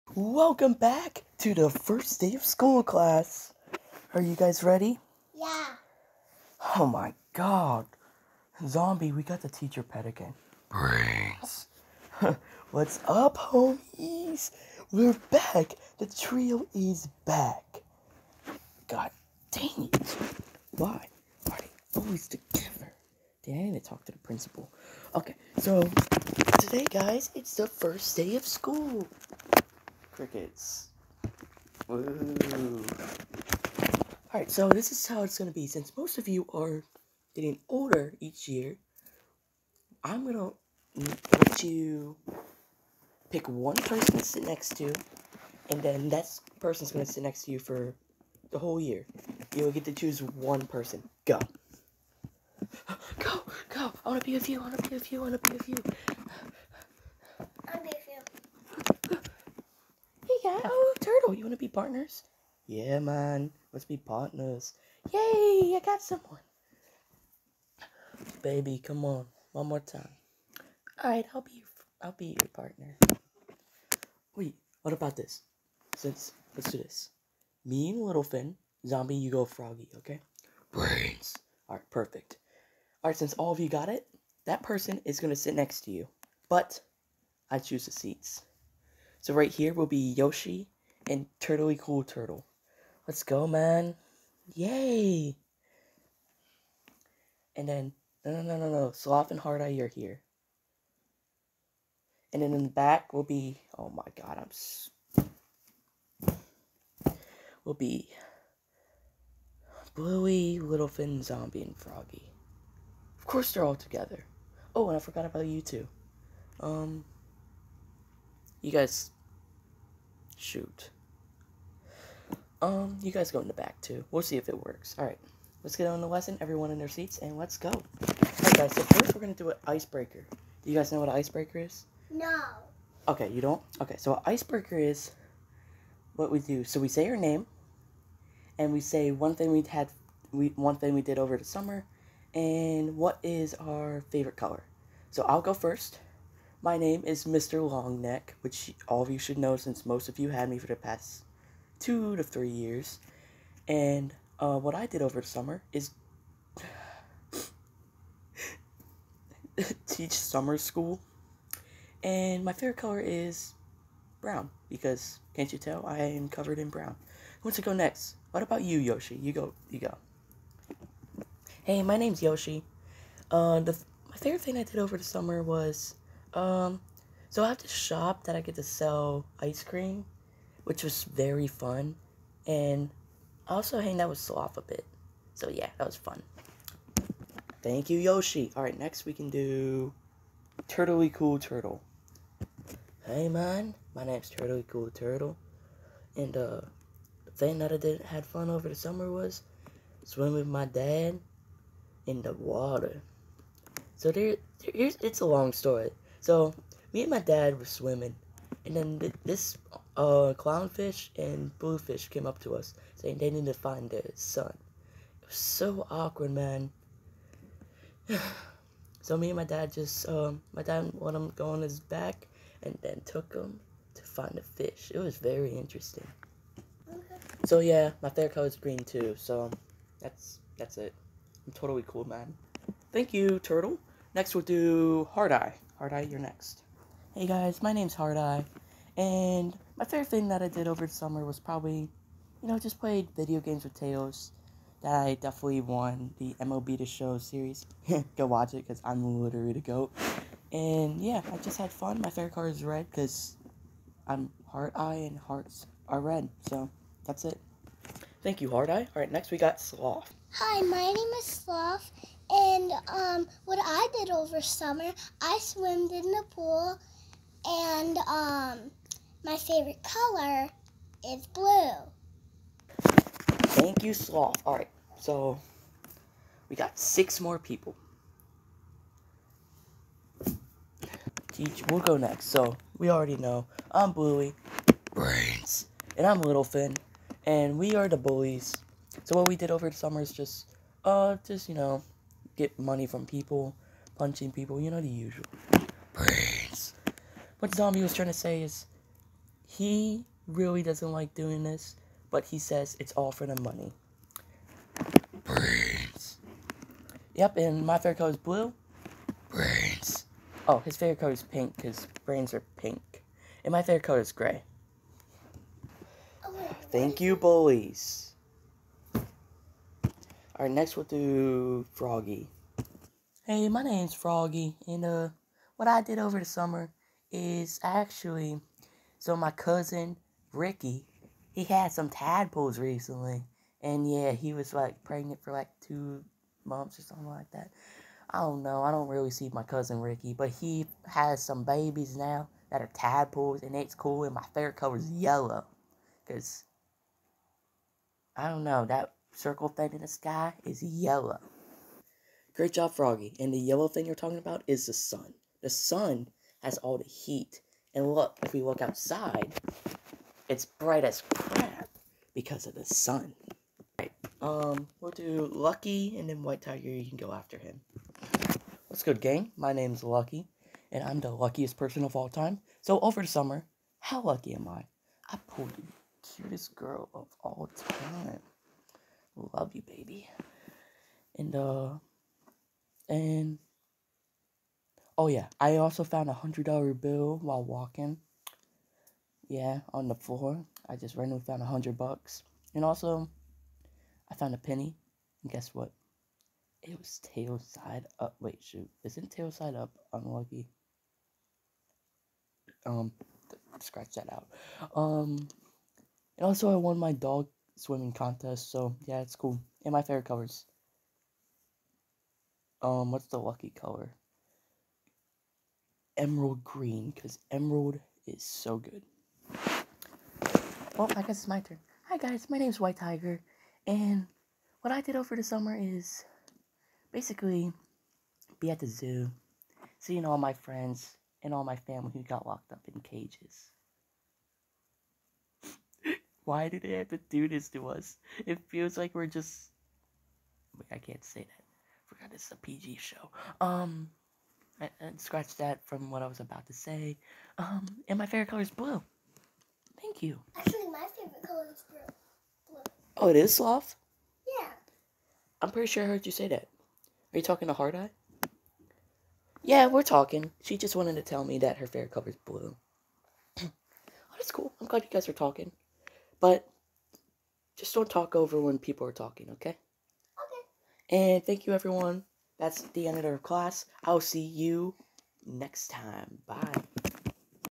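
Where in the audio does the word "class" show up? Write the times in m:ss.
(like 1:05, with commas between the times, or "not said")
0:02, 7:53.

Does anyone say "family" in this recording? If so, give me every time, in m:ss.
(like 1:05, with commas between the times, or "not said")
7:11.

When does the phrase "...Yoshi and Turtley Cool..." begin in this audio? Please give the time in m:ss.
1:30.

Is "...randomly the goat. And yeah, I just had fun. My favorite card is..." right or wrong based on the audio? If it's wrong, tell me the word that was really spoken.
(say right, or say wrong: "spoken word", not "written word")
wrong: "literally", not "randomly".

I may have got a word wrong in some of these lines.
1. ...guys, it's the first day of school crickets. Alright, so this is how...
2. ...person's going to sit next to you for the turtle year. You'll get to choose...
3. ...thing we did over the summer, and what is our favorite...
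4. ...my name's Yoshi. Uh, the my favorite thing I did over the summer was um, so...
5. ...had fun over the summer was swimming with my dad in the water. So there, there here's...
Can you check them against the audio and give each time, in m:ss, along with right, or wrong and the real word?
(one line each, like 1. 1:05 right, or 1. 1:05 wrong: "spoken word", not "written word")
1. 0:26 right
2. 0:46 wrong: "whole", not "turtle"
3. 2:20 right
4. 2:51 right
5. 3:18 right.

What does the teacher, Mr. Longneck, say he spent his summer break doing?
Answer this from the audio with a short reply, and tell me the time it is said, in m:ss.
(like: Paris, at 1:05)
Teach summer school, at 2:39.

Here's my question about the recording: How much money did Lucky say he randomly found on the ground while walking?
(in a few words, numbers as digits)
$100.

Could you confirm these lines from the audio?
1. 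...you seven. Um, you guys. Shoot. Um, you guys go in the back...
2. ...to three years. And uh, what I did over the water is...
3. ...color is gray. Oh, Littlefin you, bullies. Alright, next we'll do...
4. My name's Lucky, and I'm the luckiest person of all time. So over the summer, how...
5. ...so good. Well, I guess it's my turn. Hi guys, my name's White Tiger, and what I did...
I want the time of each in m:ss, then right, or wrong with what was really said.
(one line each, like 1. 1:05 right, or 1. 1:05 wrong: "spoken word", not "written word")
1. 1:55 wrong: "two", not "seven"
2. 2:32 wrong: "summer", not "water"
3. 5:13 wrong: "Thank", not "Littlefin"
4. 6:09 right
5. 6:58 right.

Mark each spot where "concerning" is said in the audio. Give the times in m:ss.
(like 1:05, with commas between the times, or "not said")
not said.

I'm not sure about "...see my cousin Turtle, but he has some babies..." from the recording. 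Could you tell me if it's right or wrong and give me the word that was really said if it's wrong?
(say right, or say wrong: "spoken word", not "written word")
wrong: "Ricky", not "Turtle".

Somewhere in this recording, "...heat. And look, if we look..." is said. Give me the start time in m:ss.
5:56.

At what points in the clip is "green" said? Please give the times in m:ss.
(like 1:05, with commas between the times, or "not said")
3:48, 6:56.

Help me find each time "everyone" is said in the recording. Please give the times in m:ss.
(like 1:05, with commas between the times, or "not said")
2:06, 7:51.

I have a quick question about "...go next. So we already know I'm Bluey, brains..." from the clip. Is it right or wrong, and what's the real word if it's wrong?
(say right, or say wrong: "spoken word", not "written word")
right.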